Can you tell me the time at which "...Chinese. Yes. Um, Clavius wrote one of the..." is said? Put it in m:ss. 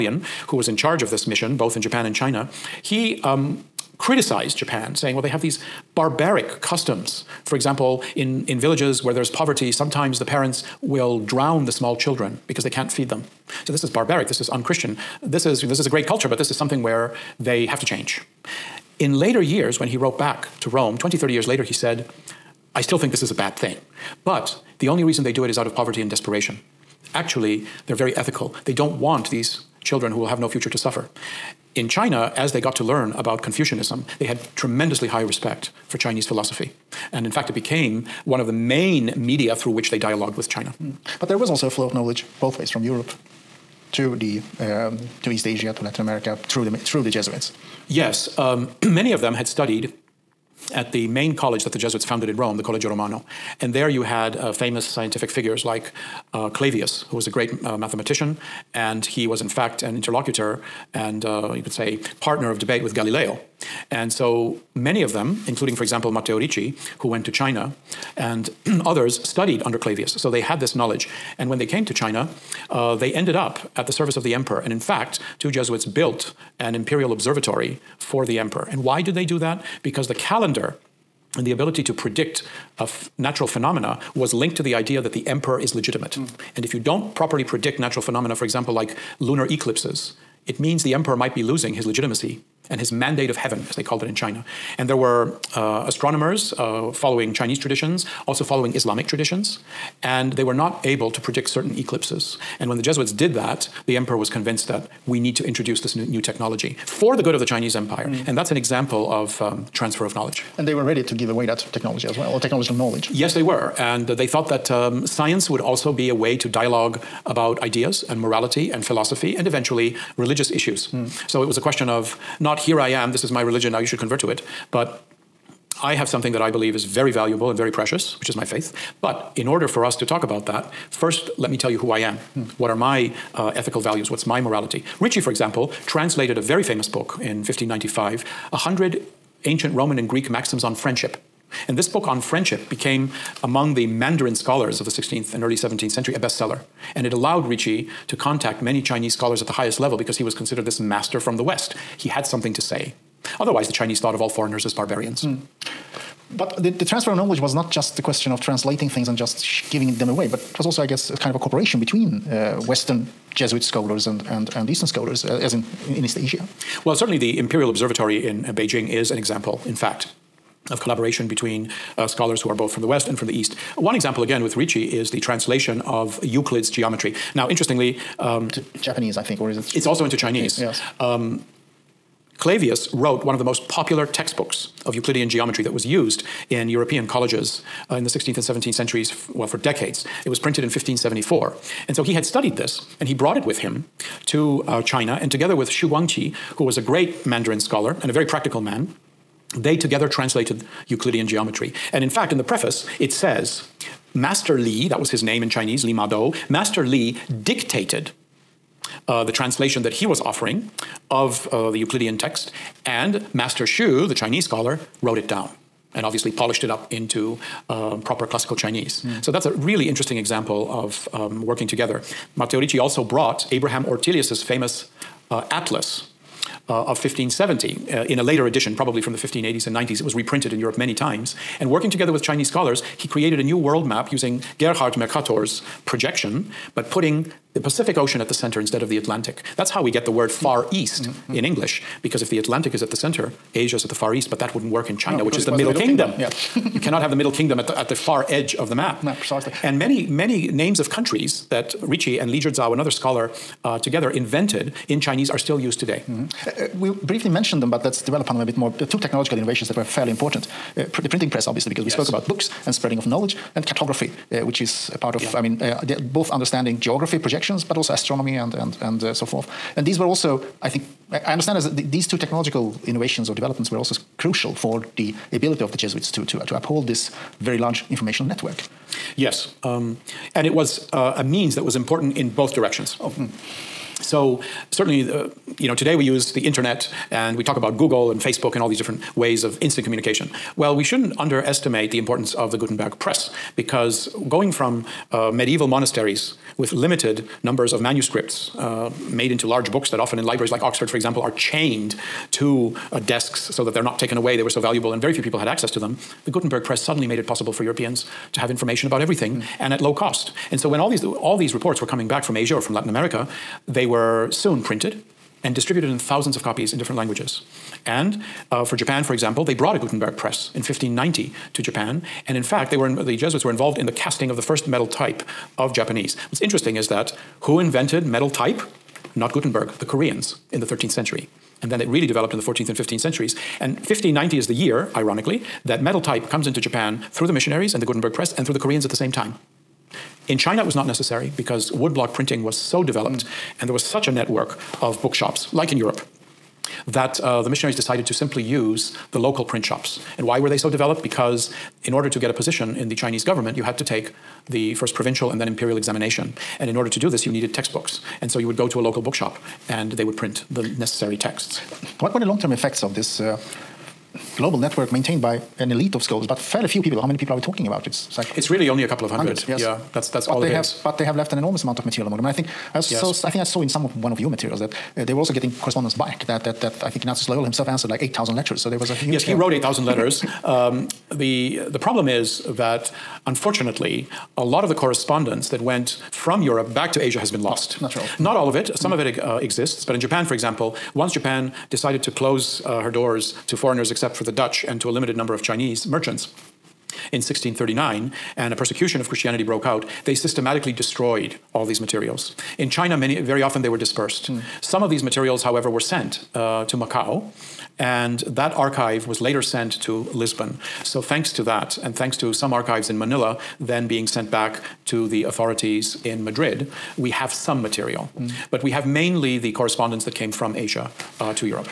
3:00.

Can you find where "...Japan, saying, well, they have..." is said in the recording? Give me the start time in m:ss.
0:04.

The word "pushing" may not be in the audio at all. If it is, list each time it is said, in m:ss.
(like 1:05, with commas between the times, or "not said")
not said.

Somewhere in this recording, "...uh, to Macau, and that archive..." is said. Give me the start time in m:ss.
6:46.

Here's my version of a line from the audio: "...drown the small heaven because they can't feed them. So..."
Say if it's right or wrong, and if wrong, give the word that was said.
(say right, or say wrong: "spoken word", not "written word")
wrong: "children", not "heaven".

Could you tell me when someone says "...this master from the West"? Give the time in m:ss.
2:30.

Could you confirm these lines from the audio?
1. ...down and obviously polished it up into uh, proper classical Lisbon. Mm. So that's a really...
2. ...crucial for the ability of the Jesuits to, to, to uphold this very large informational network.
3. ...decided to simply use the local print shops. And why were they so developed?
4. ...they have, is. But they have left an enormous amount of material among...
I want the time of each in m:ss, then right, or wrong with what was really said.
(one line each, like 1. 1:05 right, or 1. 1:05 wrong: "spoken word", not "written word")
1. 3:35 wrong: "Chinese", not "Lisbon"
2. 4:34 right
3. 5:47 right
4. 6:10 right.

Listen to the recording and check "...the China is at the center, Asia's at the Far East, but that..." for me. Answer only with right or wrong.
wrong.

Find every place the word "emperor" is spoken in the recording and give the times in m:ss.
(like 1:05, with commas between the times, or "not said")
1:14, 1:18, 1:25, 1:30, 1:43.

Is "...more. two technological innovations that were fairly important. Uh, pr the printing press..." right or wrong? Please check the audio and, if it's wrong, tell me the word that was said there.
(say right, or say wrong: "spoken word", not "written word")
right.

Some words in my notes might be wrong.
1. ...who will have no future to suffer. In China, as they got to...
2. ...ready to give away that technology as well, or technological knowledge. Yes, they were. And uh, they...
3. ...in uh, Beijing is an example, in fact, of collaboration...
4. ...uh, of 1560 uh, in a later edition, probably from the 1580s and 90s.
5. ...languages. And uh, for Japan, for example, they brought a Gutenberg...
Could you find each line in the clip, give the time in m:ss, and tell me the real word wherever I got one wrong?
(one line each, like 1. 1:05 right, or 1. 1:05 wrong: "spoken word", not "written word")
1. 0:30 right
2. 1:50 right
3. 2:48 right
4. 3:46 wrong: "1570", not "1560"
5. 5:16 right.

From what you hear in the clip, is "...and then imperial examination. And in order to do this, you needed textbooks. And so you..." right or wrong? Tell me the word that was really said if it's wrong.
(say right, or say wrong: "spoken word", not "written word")
right.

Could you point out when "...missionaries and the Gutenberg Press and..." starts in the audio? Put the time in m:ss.
5:37.